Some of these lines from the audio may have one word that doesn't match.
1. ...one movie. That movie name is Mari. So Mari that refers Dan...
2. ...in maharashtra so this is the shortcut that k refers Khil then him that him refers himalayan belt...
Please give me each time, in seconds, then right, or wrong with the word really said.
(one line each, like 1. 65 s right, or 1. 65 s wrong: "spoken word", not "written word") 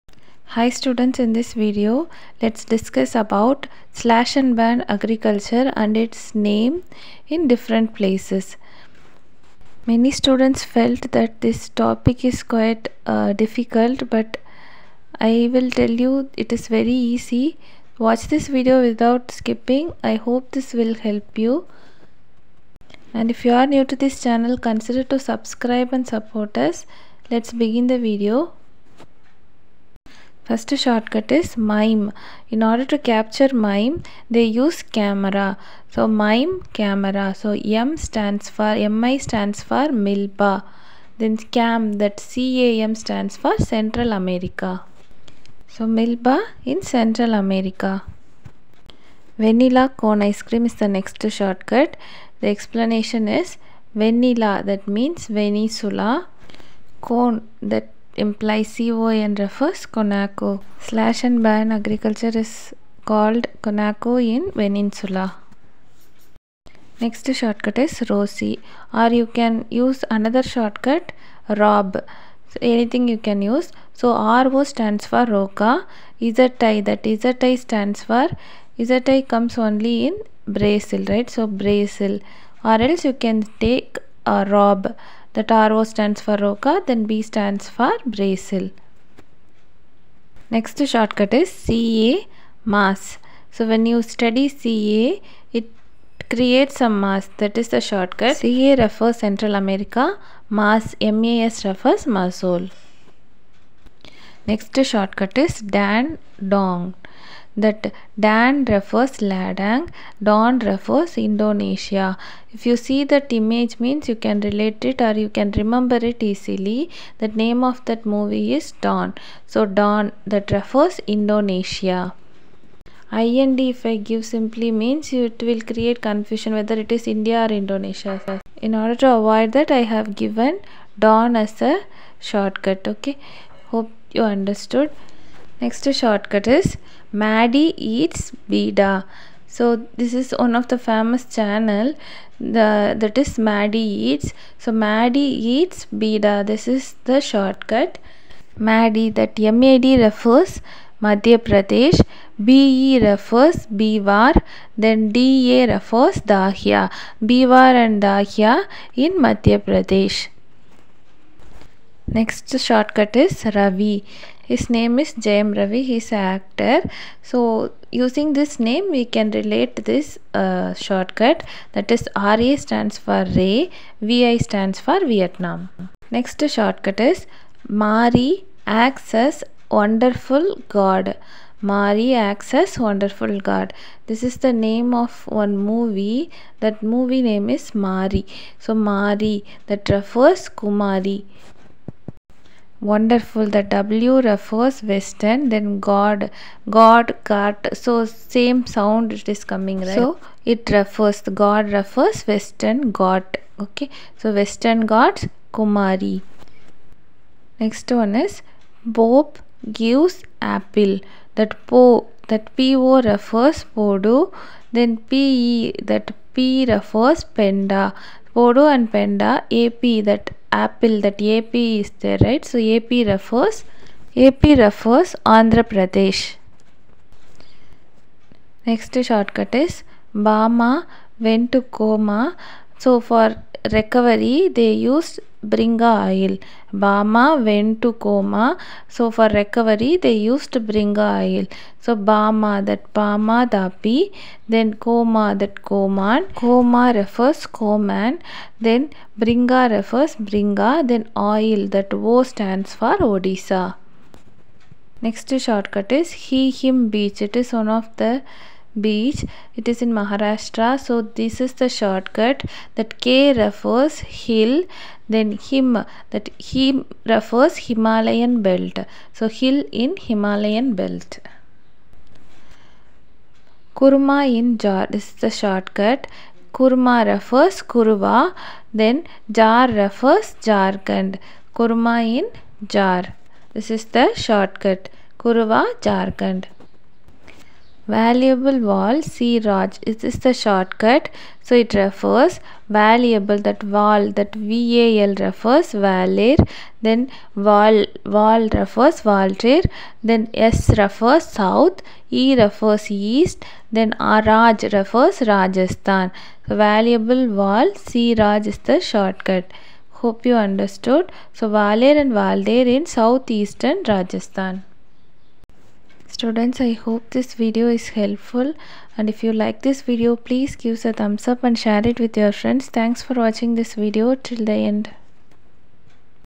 1. 185 s wrong: "Kumari", not "Dan"
2. 259 s right.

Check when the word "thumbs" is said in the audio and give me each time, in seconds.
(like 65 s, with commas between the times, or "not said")
321 s.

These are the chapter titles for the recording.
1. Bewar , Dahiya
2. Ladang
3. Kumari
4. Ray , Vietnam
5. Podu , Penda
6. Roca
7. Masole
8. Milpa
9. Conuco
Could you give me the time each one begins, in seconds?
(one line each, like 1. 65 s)
1. 138 s
2. 106 s
3. 177 s
4. 163 s
5. 207 s
6. 69 s
7. 93 s
8. 32 s
9. 50 s.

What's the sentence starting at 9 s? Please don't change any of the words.
Many students felt that this topic is quite uh, difficult but I will tell you it is very easy.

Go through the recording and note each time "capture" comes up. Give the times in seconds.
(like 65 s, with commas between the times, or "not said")
32 s.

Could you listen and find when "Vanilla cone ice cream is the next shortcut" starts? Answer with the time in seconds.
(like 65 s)
49 s.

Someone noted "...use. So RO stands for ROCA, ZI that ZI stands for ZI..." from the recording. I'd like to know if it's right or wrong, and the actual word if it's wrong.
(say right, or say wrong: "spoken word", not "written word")
right.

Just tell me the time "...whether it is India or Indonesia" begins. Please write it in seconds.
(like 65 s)
126 s.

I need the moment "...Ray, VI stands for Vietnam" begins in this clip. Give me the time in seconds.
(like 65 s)
173 s.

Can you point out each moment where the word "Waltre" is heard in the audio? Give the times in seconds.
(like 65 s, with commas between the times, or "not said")
299 s, 312 s.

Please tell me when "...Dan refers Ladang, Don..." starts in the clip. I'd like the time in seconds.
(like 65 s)
108 s.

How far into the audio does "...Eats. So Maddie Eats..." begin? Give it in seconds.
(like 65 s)
144 s.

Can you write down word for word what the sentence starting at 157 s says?
Bewar and Dahiya in Madhya Pradesh.